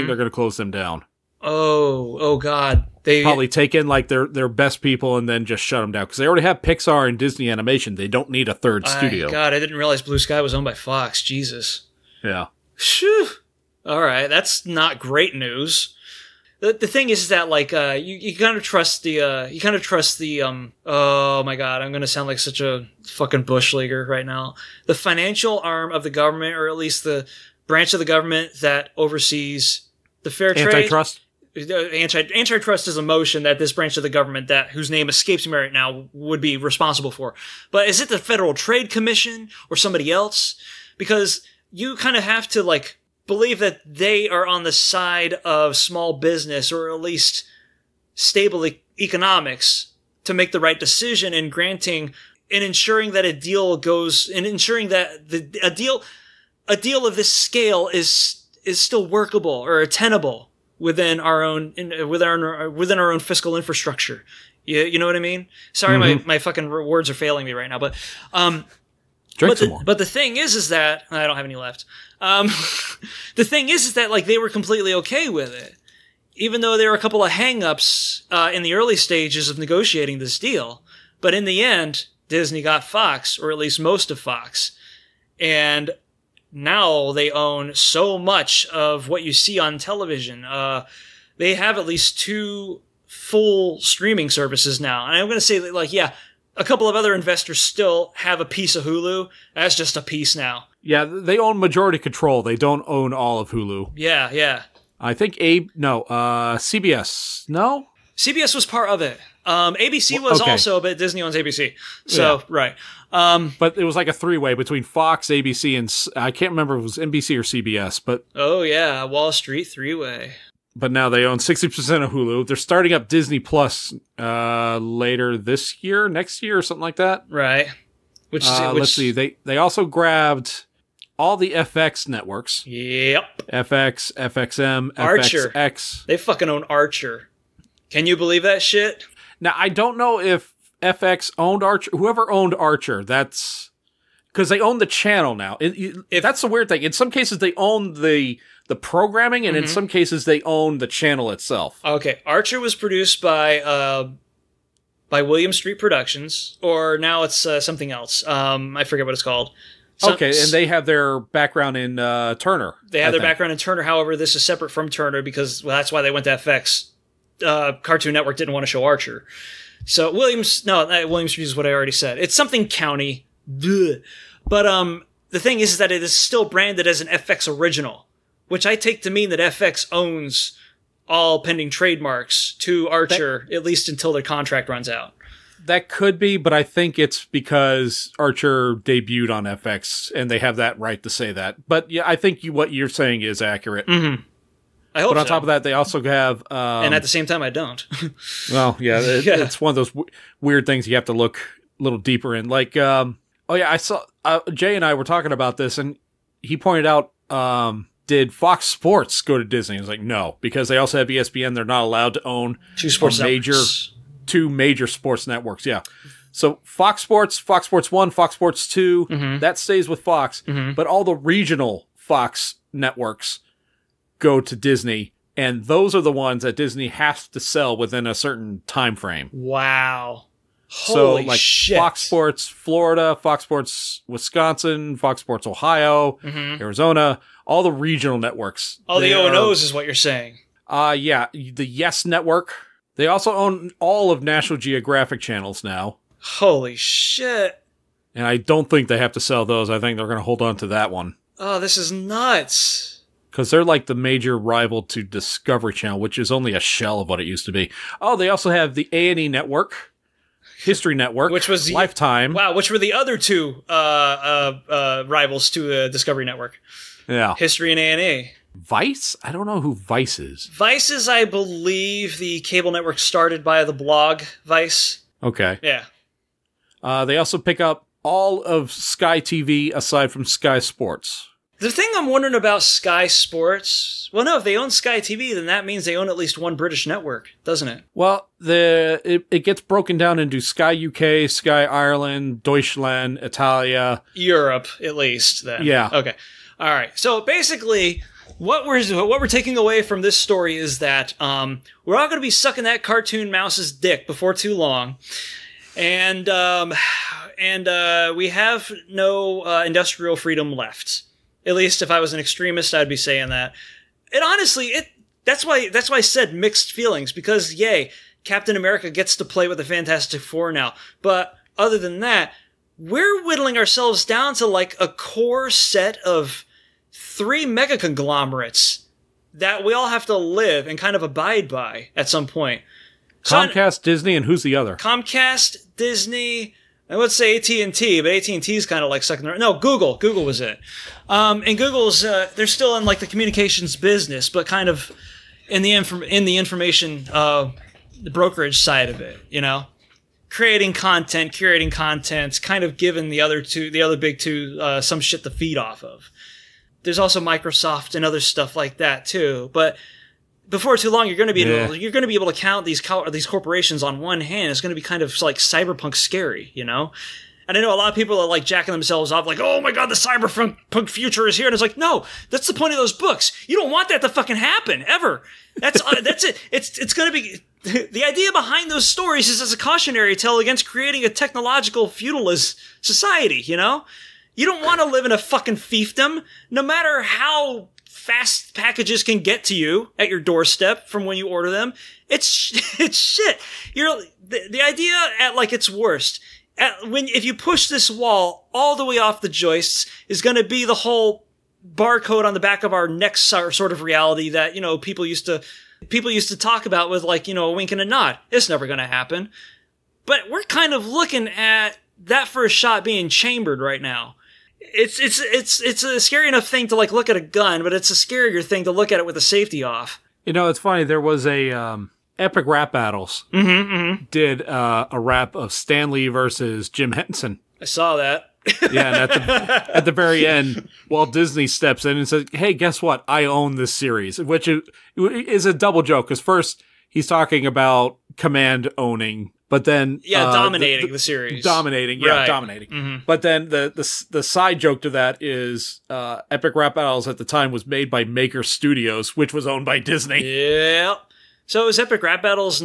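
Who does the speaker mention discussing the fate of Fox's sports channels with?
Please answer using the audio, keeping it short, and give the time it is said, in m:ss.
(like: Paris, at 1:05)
Jay, at 3:24.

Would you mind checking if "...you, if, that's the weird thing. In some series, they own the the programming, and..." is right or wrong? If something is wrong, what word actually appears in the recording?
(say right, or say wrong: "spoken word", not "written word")
wrong: "cases", not "series".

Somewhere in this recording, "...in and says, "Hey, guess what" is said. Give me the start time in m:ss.
7:11.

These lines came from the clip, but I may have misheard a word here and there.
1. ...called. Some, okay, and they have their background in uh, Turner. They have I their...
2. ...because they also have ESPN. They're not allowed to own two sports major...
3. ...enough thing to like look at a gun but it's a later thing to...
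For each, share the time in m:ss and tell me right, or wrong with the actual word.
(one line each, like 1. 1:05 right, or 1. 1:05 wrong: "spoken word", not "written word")
1. 2:39 right
2. 3:30 right
3. 6:56 wrong: "scarier", not "later".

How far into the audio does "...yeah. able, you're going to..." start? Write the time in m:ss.
6:01.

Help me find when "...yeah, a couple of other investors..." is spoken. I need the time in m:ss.
1:35.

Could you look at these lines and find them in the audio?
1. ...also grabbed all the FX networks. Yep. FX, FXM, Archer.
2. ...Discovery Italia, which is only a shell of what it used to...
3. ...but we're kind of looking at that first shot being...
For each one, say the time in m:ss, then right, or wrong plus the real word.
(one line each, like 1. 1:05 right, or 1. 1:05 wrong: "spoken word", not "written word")
1. 2:09 right
2. 4:15 wrong: "Channel", not "Italia"
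3. 6:50 right.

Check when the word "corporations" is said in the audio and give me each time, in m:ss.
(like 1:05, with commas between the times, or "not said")
6:03.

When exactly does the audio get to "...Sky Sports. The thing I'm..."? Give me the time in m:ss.
4:40.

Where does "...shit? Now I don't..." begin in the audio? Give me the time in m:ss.
2:18.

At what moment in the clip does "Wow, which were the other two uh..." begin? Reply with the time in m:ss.
4:22.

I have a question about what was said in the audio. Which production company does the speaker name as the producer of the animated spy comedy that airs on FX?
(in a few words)
William Street Productions.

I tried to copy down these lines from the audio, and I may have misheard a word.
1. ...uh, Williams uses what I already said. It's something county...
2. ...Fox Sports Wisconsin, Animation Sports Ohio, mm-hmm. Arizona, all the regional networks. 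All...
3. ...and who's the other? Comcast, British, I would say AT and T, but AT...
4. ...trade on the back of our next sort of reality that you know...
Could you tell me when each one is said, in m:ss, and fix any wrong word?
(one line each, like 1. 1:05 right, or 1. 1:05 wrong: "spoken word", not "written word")
1. 2:50 right
2. 3:53 wrong: "Fox", not "Animation"
3. 5:34 wrong: "Disney", not "British"
4. 6:41 wrong: "barcode", not "trade".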